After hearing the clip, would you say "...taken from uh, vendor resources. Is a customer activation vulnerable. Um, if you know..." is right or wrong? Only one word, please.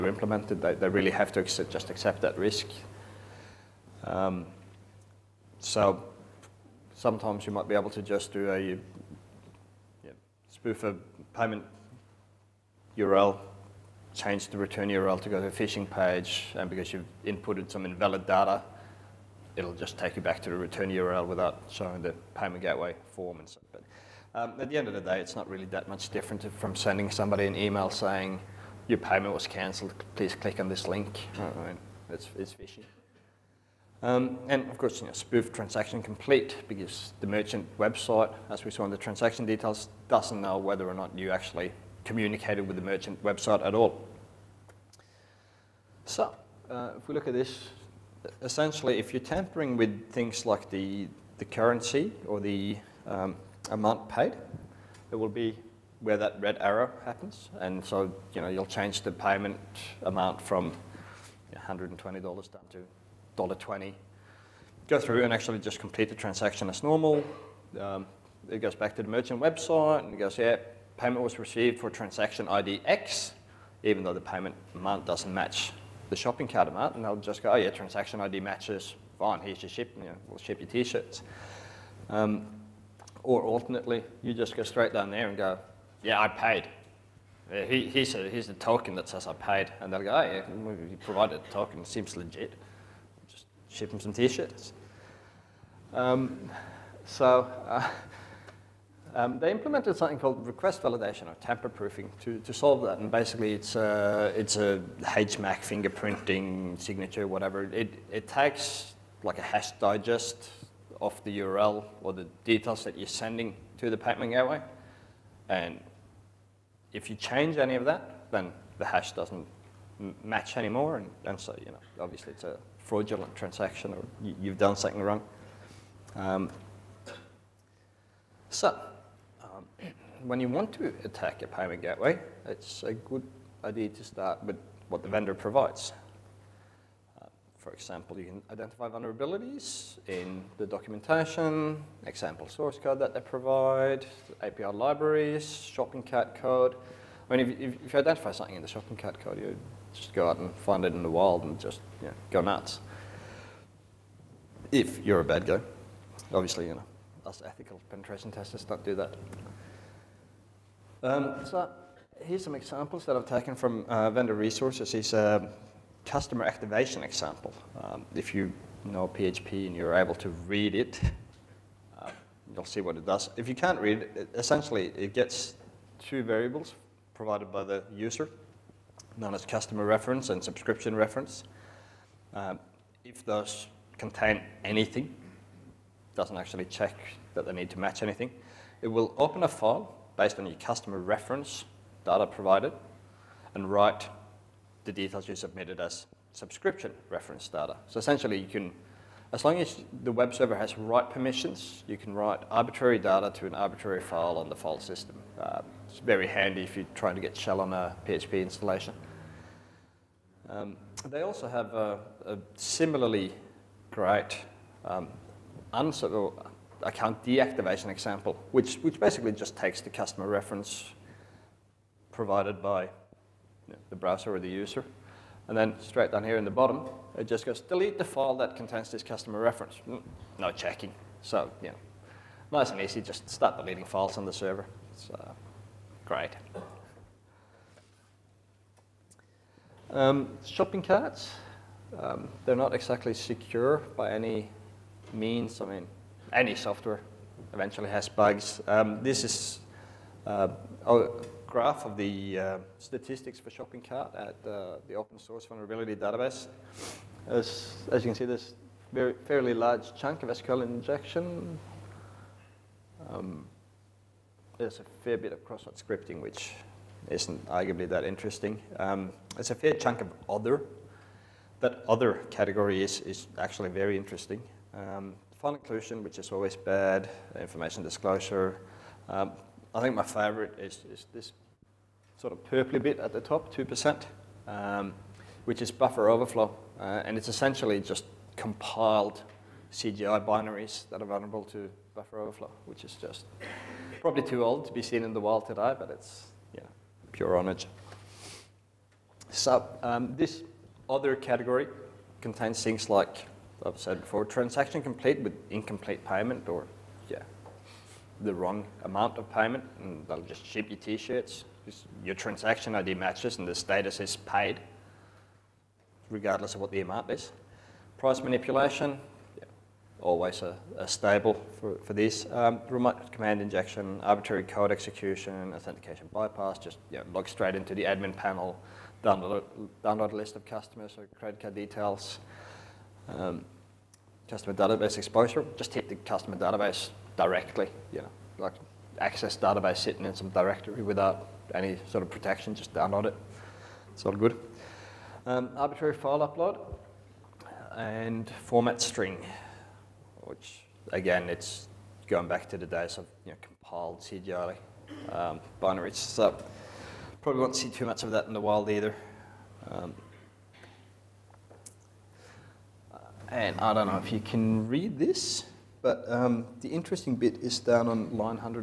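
wrong.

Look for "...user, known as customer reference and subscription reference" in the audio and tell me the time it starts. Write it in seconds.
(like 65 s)
177 s.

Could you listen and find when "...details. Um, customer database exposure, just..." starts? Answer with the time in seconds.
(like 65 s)
331 s.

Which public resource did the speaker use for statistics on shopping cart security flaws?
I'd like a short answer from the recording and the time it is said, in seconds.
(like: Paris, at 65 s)
open source vulnerability database, at 254 s.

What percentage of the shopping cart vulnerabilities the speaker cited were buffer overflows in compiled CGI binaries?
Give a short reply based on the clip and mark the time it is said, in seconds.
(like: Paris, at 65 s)
2%, at 283 s.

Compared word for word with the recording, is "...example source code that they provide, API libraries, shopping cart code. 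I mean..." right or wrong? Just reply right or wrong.
right.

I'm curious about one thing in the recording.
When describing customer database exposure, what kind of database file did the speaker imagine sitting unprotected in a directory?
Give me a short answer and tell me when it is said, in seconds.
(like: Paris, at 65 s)
access database, at 338 s.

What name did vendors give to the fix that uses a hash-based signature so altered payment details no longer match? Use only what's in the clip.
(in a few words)
request validation.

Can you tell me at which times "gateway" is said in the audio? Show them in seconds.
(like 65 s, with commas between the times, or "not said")
22 s, 114 s, 131 s.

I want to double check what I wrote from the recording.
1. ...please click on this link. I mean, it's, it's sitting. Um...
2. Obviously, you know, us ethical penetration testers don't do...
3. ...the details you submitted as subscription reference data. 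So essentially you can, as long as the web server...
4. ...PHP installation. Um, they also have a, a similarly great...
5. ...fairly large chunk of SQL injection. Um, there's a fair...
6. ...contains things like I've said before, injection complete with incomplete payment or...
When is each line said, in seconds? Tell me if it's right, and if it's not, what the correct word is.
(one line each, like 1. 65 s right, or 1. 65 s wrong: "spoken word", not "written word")
1. 30 s wrong: "phishing", not "sitting"
2. 156 s right
3. 194 s right
4. 208 s right
5. 259 s right
6. 302 s wrong: "transaction", not "injection".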